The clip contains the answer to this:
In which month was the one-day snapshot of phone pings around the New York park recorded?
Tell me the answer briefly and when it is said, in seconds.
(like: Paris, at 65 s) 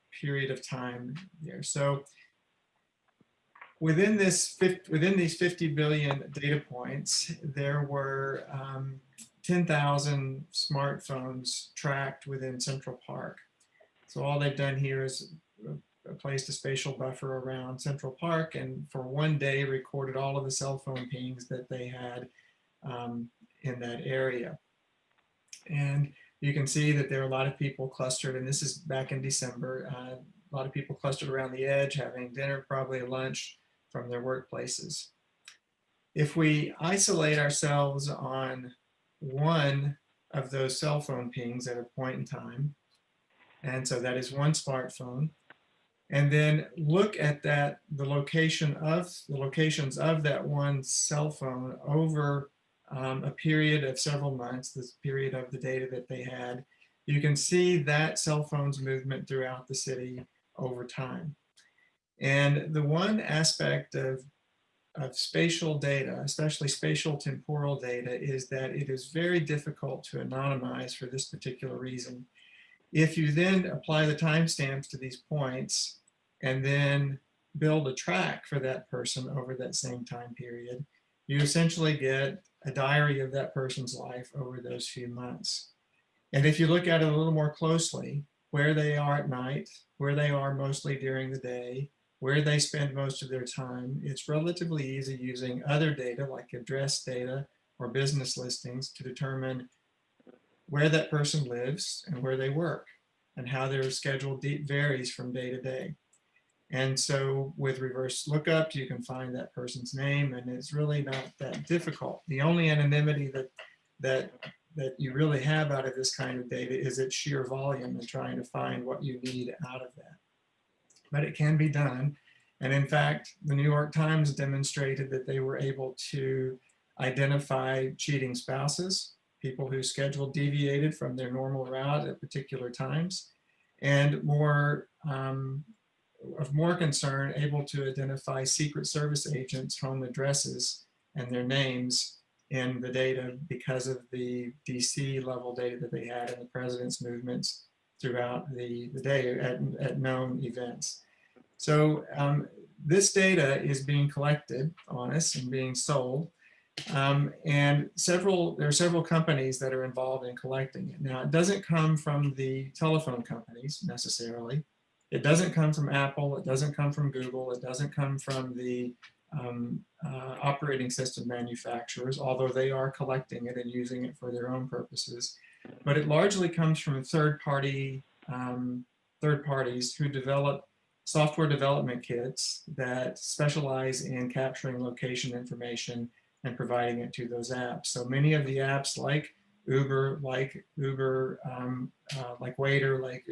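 December, at 29 s.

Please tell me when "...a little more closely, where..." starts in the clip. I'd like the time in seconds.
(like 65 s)
87 s.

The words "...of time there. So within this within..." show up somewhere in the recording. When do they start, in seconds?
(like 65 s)
0 s.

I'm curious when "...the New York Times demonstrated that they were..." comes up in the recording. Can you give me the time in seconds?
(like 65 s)
123 s.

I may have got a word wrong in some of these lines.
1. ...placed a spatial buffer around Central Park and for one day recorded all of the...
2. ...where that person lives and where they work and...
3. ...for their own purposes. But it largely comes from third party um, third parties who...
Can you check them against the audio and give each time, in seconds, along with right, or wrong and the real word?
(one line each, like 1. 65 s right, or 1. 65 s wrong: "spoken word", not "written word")
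1. 16 s right
2. 100 s right
3. 174 s right.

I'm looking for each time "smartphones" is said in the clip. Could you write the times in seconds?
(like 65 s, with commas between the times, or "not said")
10 s, 44 s.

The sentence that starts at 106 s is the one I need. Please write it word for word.
And so with reverse lookup, you can find that person's name and it's really not that difficult.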